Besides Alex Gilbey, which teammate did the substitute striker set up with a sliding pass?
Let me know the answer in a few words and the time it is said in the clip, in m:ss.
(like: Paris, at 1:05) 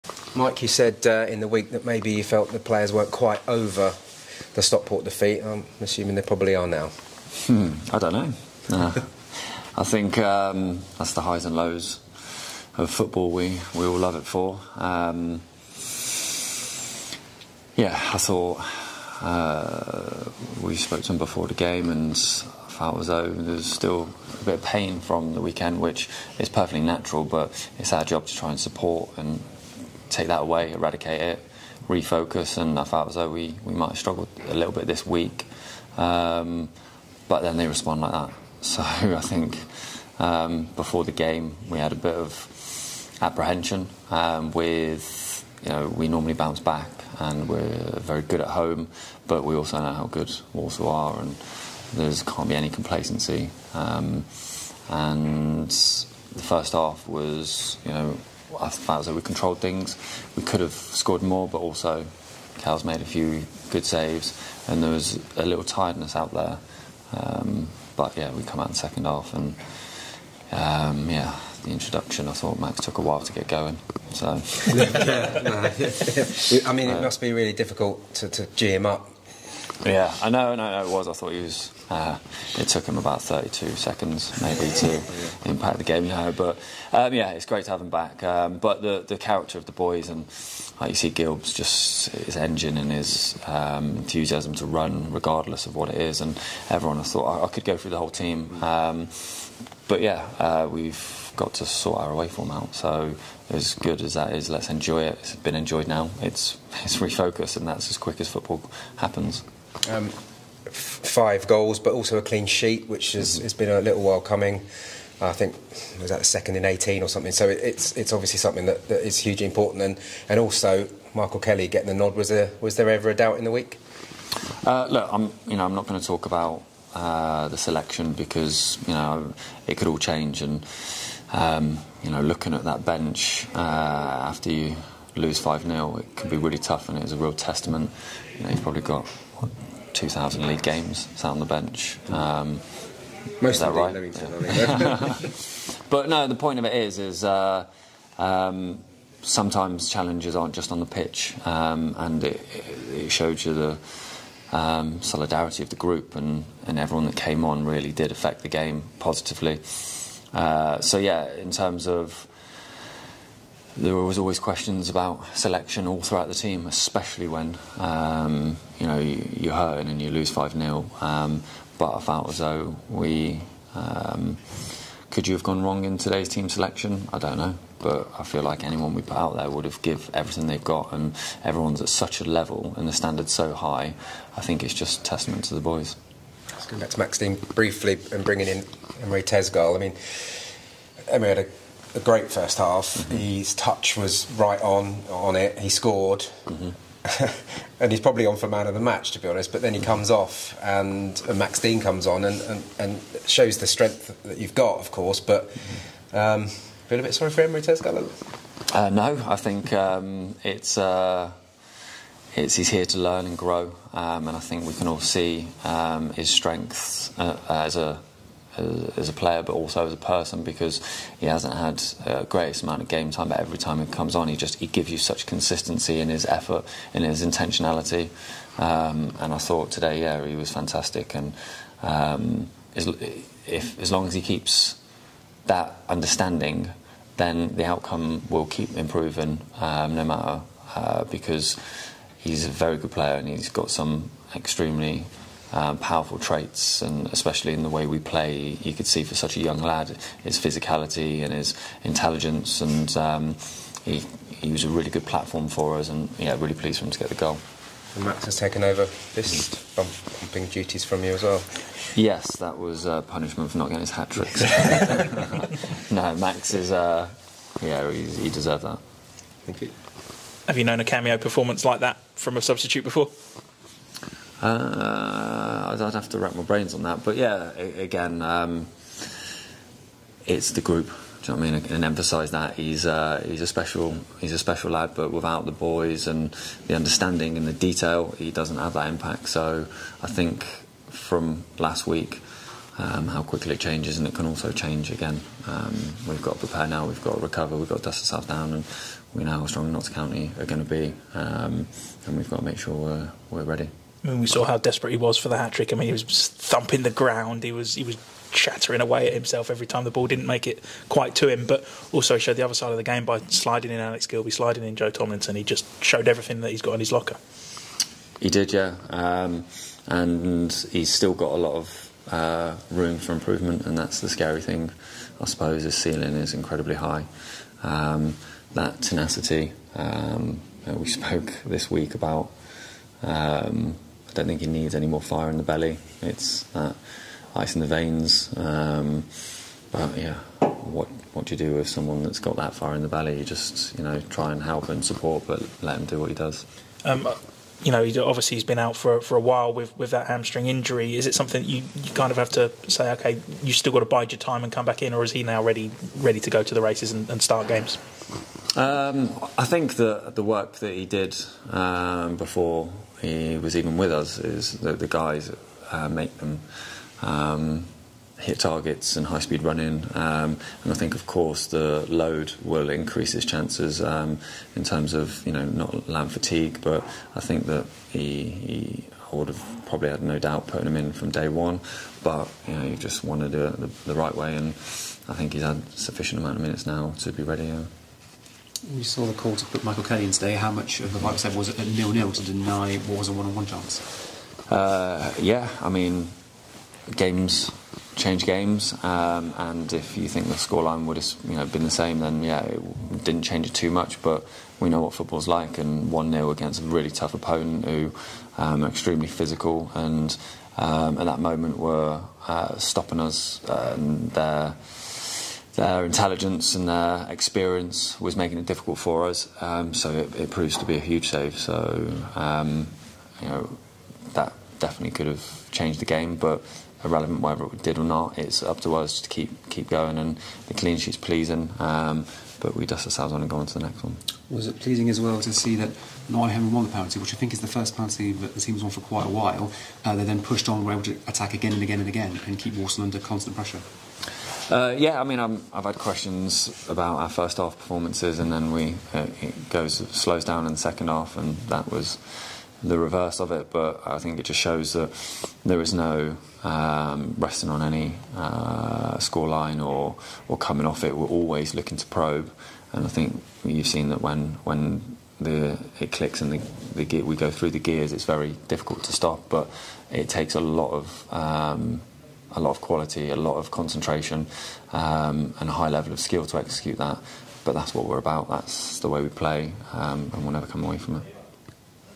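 Joe Tomlinson, at 5:14.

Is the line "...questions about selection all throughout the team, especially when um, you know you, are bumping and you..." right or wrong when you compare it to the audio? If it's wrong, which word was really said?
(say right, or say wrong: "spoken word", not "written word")
wrong: "hurting", not "bumping".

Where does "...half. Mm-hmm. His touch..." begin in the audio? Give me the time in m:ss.
3:12.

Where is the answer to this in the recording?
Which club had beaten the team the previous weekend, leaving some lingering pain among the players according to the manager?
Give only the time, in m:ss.
0:04.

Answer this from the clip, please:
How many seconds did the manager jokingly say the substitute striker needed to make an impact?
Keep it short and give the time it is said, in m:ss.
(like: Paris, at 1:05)
32 seconds, at 1:23.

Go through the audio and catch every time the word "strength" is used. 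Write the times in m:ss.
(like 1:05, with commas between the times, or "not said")
3:23, 3:36.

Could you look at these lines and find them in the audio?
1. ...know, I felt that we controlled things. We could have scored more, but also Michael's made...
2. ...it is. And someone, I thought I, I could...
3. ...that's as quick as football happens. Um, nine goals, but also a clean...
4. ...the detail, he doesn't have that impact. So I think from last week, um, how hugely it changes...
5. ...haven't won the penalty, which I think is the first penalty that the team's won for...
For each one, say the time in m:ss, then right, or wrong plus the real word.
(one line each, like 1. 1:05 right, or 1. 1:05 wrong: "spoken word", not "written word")
1. 0:57 wrong: "Cal", not "Michael"
2. 1:35 wrong: "everyone", not "someone"
3. 1:47 wrong: "five", not "nine"
4. 4:47 wrong: "quickly", not "hugely"
5. 7:16 right.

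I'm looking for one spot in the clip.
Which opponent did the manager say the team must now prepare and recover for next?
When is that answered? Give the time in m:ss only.
4:59.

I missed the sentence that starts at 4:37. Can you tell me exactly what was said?
But yeah, again, um, it's the group.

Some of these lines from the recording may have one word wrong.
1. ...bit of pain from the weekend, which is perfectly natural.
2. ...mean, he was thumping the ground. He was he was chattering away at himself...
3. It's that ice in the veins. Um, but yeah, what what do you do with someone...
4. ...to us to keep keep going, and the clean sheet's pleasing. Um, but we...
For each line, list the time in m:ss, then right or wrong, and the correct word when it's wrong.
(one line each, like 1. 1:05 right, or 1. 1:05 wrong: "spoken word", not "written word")
1. 0:24 right
2. 5:05 right
3. 5:36 right
4. 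7:08 right.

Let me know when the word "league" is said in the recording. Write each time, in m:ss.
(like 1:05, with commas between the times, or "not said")
2:20.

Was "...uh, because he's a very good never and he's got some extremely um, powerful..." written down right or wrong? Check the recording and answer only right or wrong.
wrong.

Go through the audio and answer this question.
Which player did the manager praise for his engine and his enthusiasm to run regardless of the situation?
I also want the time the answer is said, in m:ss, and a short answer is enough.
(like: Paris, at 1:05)
Gilbs, at 1:31.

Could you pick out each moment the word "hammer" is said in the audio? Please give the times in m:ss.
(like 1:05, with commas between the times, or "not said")
not said.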